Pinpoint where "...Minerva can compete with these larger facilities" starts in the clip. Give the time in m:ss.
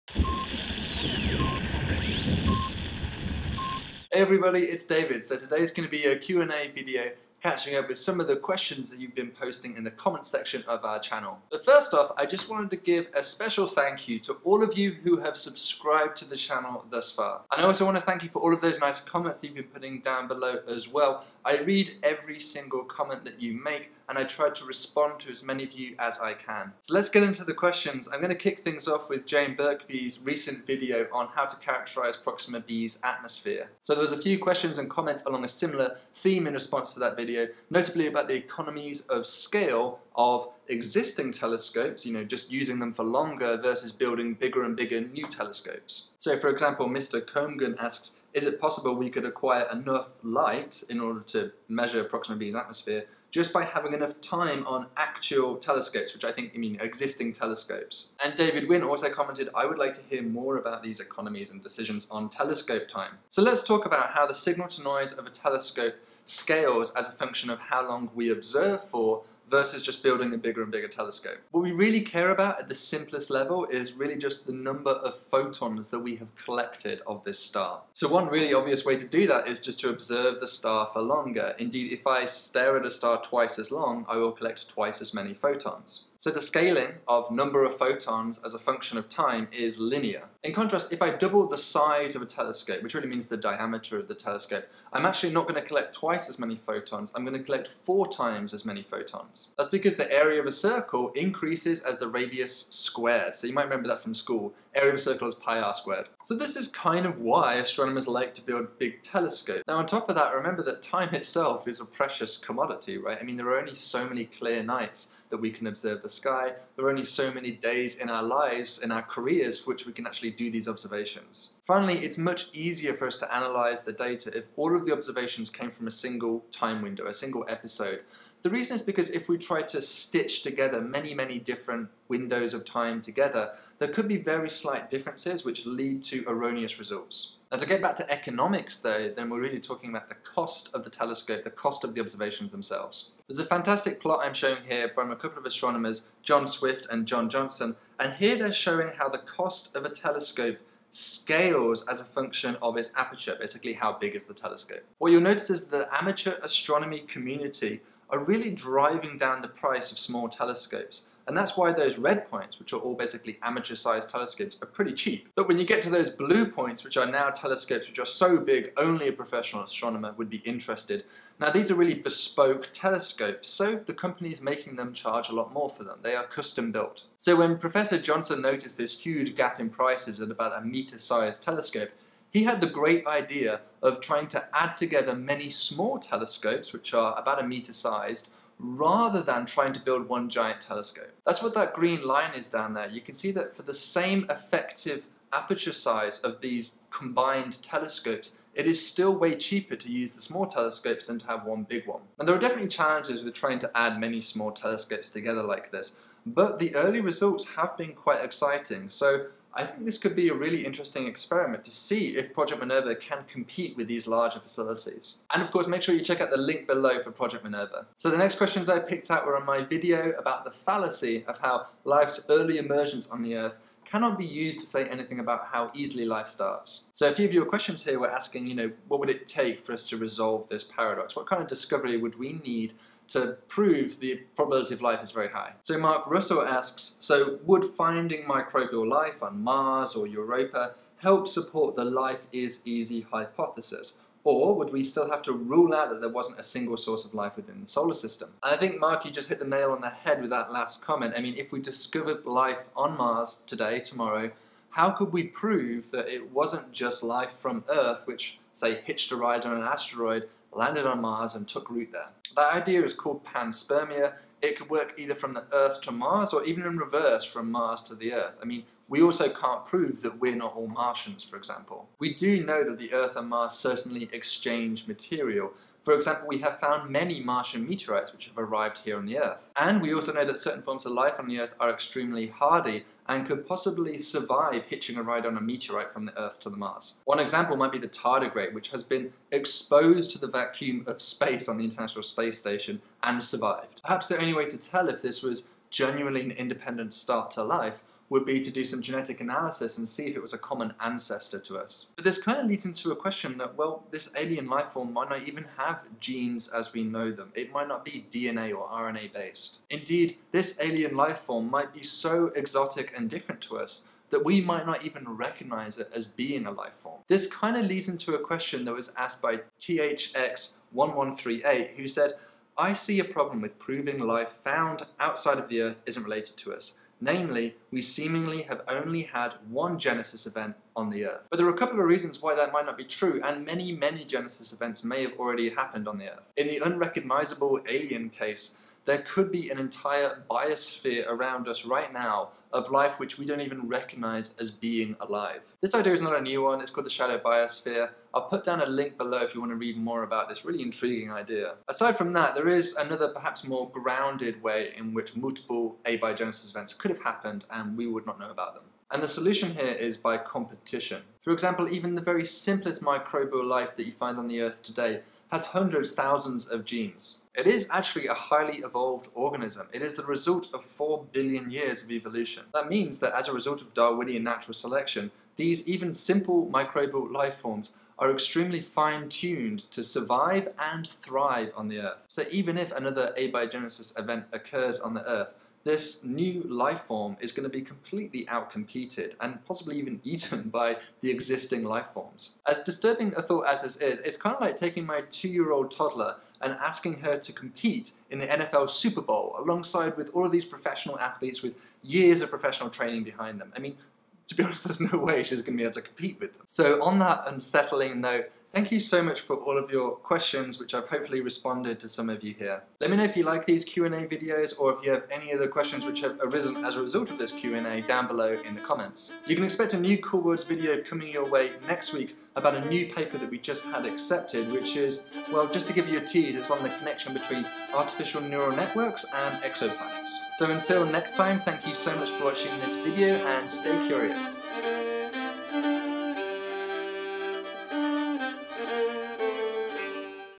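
3:32.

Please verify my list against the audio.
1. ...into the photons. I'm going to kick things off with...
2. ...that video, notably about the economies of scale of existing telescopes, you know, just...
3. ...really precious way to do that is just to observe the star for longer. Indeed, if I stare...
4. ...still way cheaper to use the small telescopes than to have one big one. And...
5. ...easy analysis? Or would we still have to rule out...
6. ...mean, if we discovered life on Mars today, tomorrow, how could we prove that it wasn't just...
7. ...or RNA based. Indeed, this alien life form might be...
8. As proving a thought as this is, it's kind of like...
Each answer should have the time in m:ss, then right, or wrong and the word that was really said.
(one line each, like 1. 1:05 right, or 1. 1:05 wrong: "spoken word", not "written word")
1. 0:27 wrong: "questions", not "photons"
2. 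0:36 right
3. 1:18 wrong: "obvious", not "precious"
4. 3:18 right
5. 4:02 wrong: "hypothesis", not "analysis"
6. 4:11 right
7. 5:08 right
8. 6:32 wrong: "disturbing", not "proving".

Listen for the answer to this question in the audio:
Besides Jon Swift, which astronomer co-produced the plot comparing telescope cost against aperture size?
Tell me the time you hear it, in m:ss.
2:27.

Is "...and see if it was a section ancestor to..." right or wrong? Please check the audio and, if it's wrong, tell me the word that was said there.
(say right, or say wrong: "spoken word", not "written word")
wrong: "common", not "section".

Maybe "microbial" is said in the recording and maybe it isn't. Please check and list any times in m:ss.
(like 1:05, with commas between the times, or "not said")
3:58, 6:02, 6:16.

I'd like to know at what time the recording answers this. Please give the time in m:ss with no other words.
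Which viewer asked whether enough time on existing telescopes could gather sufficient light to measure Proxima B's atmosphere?
0:46.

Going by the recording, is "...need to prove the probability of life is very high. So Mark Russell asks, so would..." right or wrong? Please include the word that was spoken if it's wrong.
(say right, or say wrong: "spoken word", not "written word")
right.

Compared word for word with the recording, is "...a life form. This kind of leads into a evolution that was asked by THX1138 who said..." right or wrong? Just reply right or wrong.
wrong.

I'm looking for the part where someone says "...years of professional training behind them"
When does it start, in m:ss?
6:41.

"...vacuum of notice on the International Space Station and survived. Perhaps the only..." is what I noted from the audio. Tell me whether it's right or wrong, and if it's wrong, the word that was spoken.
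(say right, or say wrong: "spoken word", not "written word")
wrong: "space", not "notice".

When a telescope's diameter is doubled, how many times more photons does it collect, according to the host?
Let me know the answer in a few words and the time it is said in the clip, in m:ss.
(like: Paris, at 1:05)
4 times, at 1:37.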